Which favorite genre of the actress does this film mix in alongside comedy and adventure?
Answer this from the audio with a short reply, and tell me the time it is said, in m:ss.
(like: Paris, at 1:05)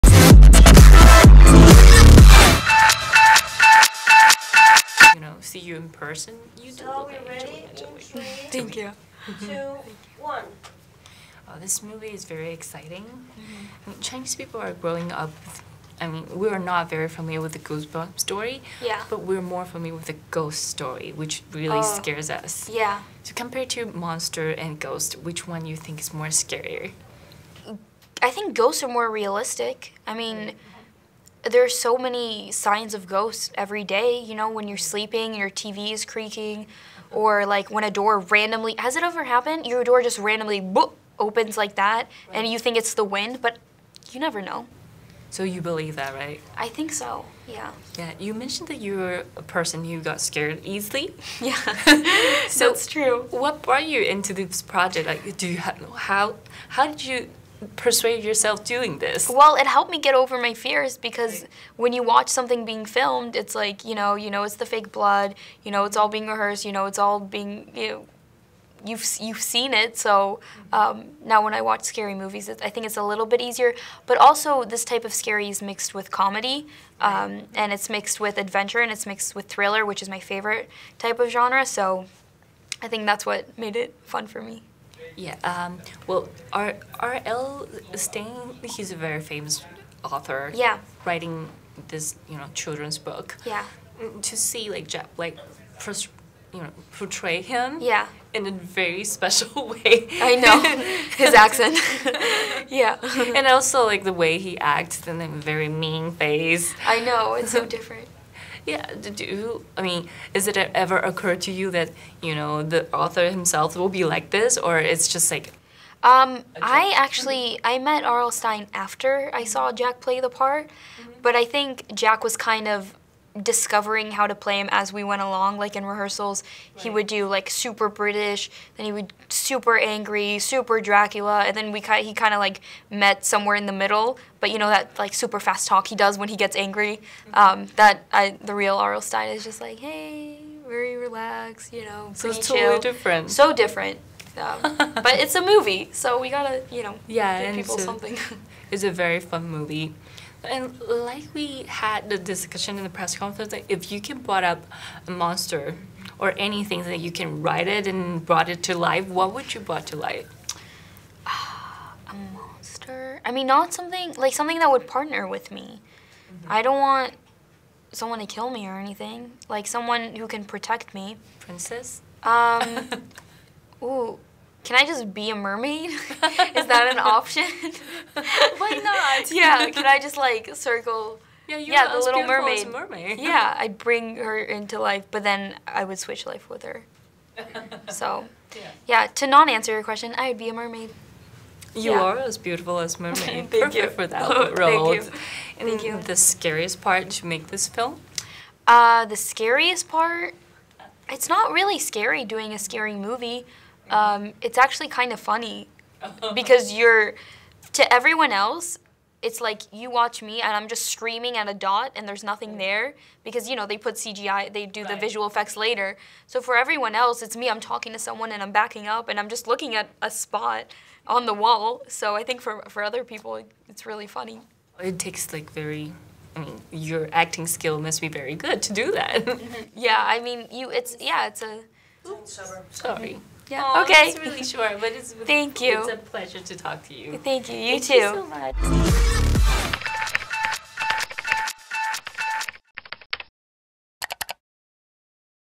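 Thriller, at 1:19.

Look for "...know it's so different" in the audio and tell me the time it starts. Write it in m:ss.
1:47.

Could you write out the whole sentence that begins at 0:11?
Oh, this movie is very exciting.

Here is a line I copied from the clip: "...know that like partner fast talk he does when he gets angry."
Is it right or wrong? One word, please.
wrong.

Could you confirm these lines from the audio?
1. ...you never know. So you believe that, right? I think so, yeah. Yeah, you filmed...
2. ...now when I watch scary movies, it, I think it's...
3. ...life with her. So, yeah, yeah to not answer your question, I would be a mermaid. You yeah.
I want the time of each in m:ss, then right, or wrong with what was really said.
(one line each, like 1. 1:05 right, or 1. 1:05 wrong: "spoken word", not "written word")
1. 0:44 wrong: "mentioned", not "filmed"
2. 1:11 right
3. 3:06 right.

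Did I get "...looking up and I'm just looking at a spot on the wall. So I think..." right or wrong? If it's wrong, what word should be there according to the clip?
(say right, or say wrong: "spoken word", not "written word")
wrong: "backing", not "looking".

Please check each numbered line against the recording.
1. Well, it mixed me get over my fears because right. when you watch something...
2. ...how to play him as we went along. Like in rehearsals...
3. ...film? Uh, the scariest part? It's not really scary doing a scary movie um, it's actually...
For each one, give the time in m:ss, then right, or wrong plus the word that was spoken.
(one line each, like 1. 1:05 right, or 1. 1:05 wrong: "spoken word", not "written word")
1. 0:59 wrong: "helped", not "mixed"
2. 2:04 right
3. 3:17 right.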